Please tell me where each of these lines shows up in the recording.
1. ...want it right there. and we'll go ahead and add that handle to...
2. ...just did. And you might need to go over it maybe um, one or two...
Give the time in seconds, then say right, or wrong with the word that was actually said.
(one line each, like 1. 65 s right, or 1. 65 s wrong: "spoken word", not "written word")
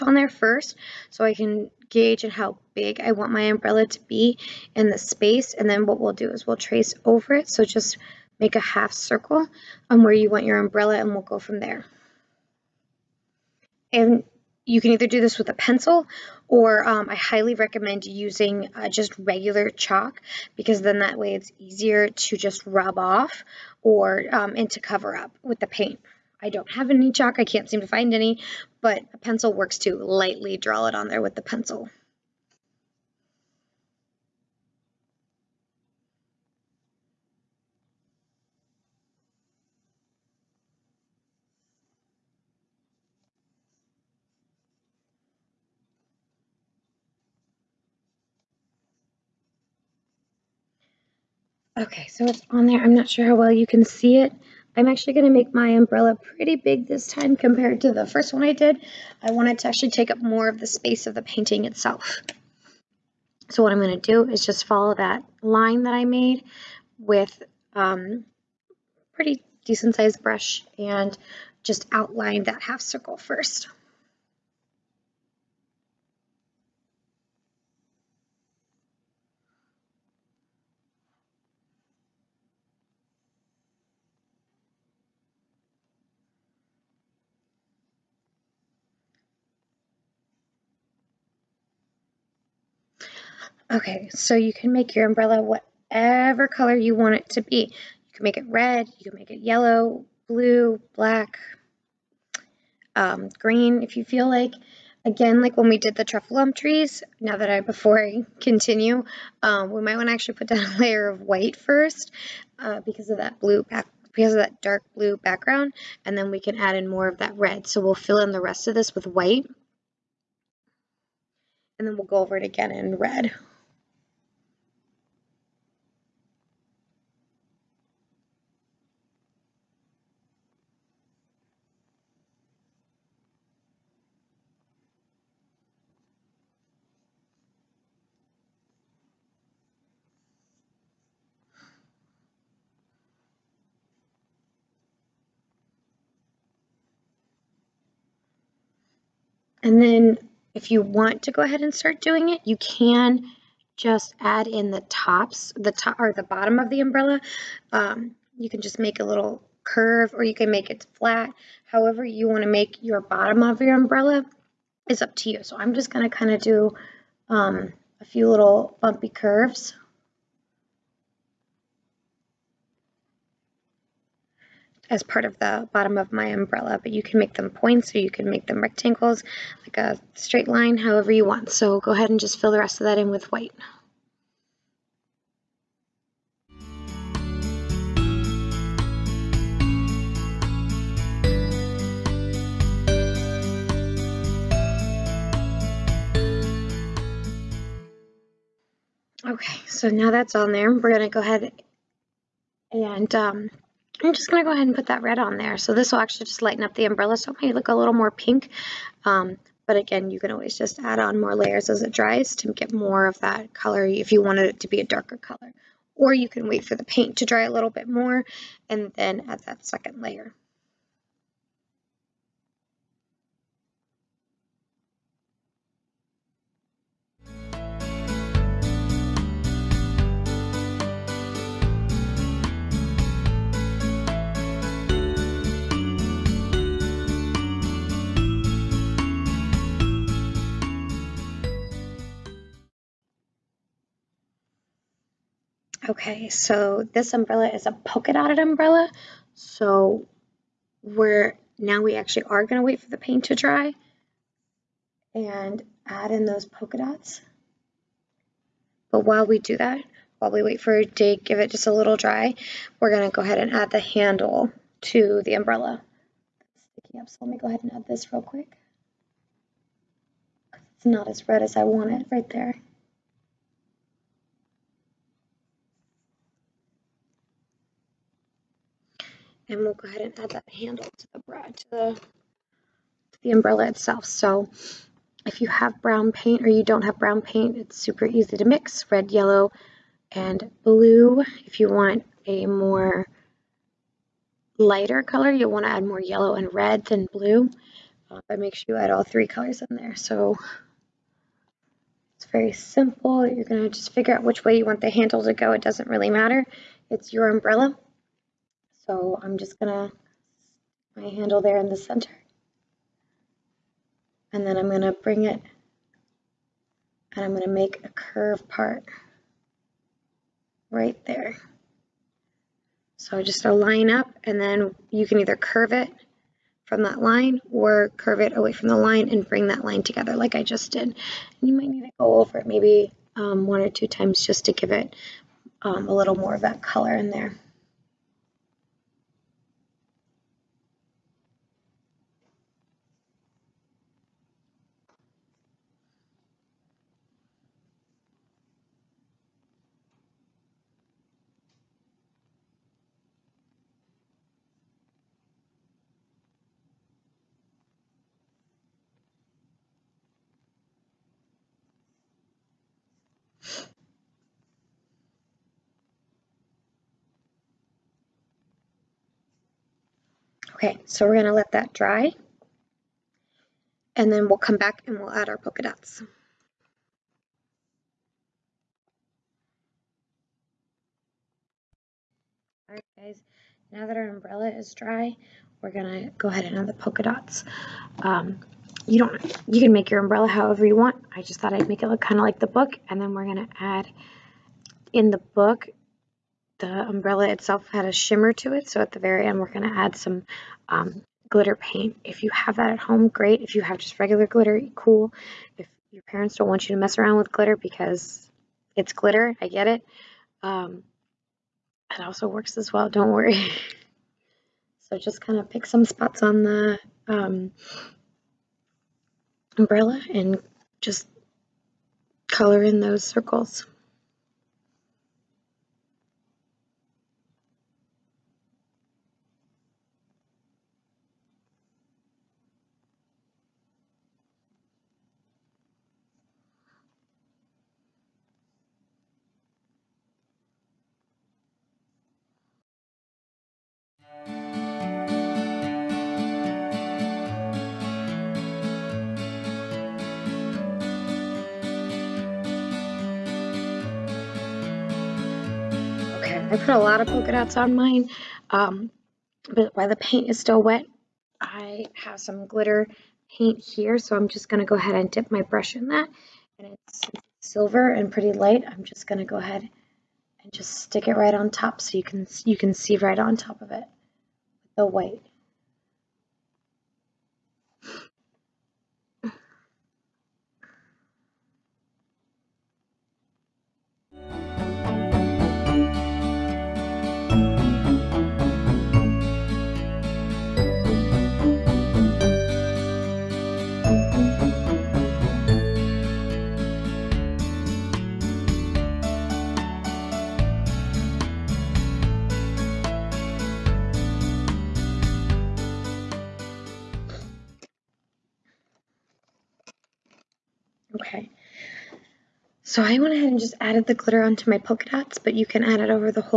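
1. 271 s right
2. 330 s right.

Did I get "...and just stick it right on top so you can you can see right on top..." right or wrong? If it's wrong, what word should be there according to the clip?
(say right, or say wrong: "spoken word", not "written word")
right.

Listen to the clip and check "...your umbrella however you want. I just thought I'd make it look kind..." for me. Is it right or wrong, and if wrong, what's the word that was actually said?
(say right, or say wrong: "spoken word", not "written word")
right.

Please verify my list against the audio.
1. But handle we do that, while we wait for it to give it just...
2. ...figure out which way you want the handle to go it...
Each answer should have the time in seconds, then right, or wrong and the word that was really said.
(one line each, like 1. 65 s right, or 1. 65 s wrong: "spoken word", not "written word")
1. 258 s wrong: "while", not "handle"
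2. 303 s right.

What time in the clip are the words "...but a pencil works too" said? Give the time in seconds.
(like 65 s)
28 s.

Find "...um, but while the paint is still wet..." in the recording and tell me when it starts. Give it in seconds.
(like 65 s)
458 s.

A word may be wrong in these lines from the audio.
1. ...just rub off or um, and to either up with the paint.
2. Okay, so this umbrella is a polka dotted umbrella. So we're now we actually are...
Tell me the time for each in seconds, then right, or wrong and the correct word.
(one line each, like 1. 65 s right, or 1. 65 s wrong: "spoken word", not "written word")
1. 22 s wrong: "cover", not "either"
2. 245 s right.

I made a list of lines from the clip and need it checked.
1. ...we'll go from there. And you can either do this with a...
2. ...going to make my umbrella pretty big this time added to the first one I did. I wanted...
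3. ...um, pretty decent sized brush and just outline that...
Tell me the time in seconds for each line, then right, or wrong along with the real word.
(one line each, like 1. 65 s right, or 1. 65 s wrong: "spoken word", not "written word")
1. 11 s right
2. 55 s wrong: "compared", not "added"
3. 67 s right.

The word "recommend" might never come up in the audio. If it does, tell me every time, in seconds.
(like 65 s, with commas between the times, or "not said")
17 s.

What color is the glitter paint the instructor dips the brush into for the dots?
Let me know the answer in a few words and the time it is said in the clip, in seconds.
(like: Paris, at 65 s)
Silver, at 467 s.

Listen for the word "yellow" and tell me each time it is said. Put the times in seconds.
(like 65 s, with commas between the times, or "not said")
99 s, 289 s, 296 s.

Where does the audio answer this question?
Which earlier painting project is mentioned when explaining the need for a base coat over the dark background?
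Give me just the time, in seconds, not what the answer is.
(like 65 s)
106 s.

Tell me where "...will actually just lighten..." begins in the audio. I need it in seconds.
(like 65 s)
205 s.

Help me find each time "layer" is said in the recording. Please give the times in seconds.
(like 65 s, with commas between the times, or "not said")
110 s, 211 s, 220 s.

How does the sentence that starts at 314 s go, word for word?
And then I'm gonna bring it and I'm gonna make a curve part right there.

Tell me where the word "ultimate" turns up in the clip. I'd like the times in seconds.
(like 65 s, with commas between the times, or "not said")
not said.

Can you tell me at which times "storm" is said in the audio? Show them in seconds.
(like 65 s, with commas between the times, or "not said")
not said.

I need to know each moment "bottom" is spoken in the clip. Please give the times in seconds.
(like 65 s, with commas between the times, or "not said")
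156 s, 163 s, 175 s.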